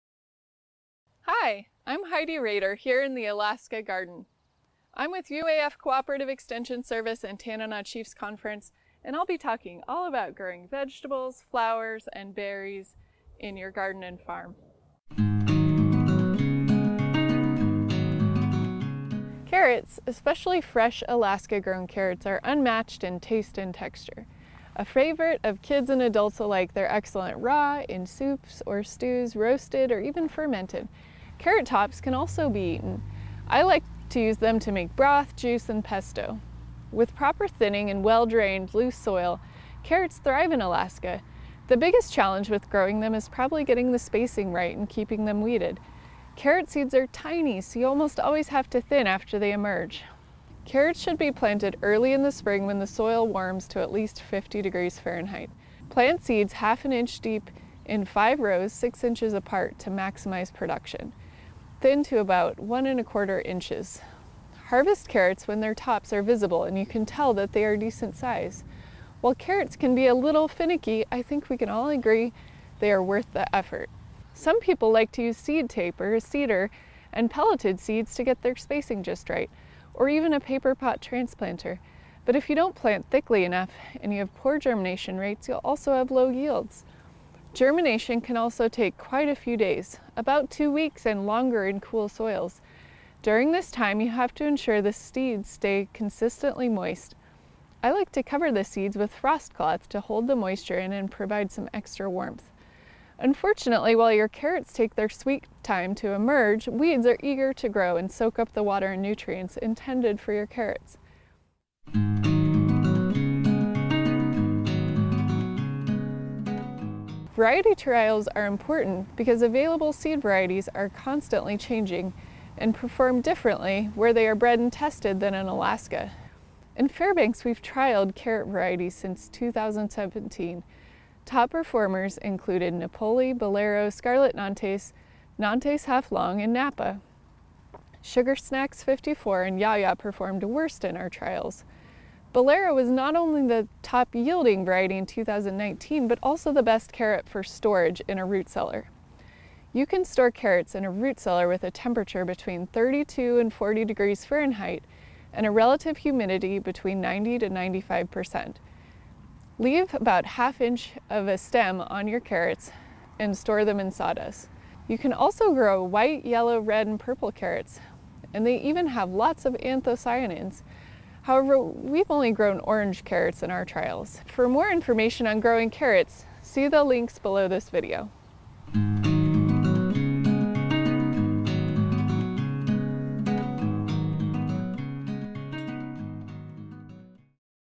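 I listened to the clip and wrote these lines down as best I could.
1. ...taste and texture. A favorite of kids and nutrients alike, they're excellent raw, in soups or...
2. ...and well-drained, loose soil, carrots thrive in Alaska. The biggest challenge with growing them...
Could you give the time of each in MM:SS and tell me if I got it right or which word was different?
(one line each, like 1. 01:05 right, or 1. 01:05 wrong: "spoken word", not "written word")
1. 00:23 wrong: "adults", not "nutrients"
2. 00:37 right.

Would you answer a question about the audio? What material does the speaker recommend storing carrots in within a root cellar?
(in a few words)
sawdust.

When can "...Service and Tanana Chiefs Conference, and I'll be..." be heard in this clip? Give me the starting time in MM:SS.
00:06.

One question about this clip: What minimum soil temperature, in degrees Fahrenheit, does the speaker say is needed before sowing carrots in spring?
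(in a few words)
50.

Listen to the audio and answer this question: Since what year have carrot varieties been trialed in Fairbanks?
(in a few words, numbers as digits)
2017.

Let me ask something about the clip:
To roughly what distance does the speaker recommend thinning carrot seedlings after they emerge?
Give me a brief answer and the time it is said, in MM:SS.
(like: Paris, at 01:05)
1 1/4 inches, at 01:02.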